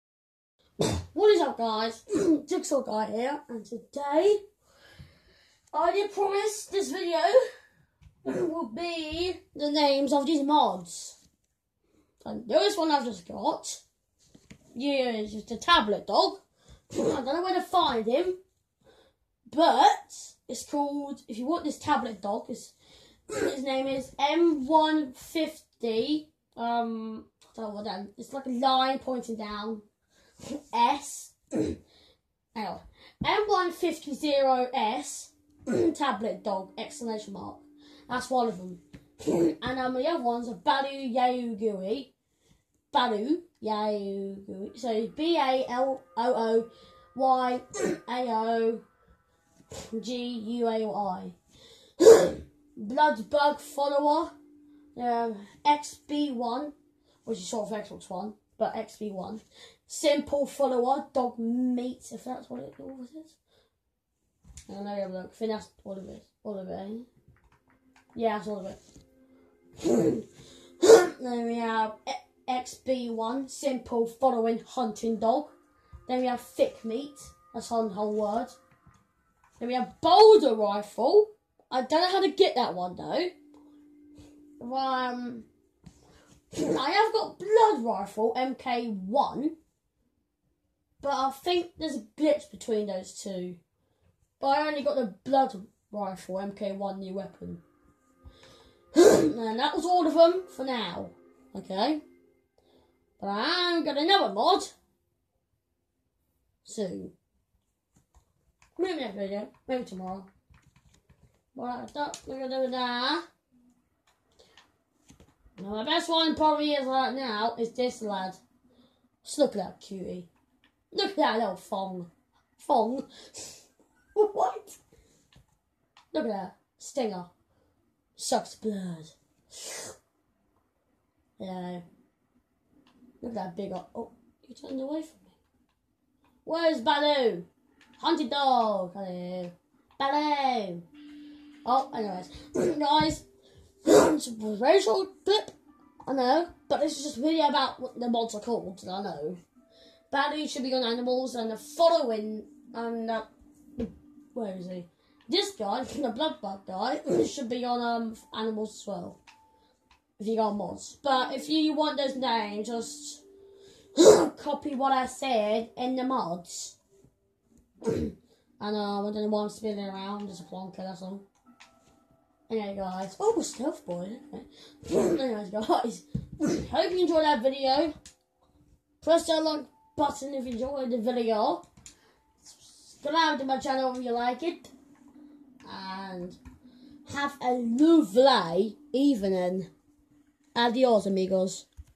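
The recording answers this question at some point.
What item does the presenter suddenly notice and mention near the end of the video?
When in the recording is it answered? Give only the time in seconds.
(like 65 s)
173 s.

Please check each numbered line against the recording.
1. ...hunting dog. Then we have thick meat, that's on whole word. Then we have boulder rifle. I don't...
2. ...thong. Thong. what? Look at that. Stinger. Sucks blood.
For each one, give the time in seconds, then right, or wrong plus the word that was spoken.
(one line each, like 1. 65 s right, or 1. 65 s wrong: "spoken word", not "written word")
1. 74 s right
2. 121 s right.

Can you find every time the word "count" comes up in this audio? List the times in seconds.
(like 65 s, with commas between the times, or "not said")
not said.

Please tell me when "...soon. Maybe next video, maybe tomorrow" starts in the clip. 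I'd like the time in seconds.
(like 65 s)
106 s.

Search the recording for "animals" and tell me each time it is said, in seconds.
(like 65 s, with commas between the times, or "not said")
150 s, 158 s.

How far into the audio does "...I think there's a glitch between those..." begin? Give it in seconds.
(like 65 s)
91 s.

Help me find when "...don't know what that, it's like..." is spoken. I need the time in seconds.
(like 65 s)
27 s.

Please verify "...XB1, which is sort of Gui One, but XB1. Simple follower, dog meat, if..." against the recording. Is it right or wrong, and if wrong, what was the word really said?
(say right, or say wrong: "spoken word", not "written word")
wrong: "Xbox", not "Gui".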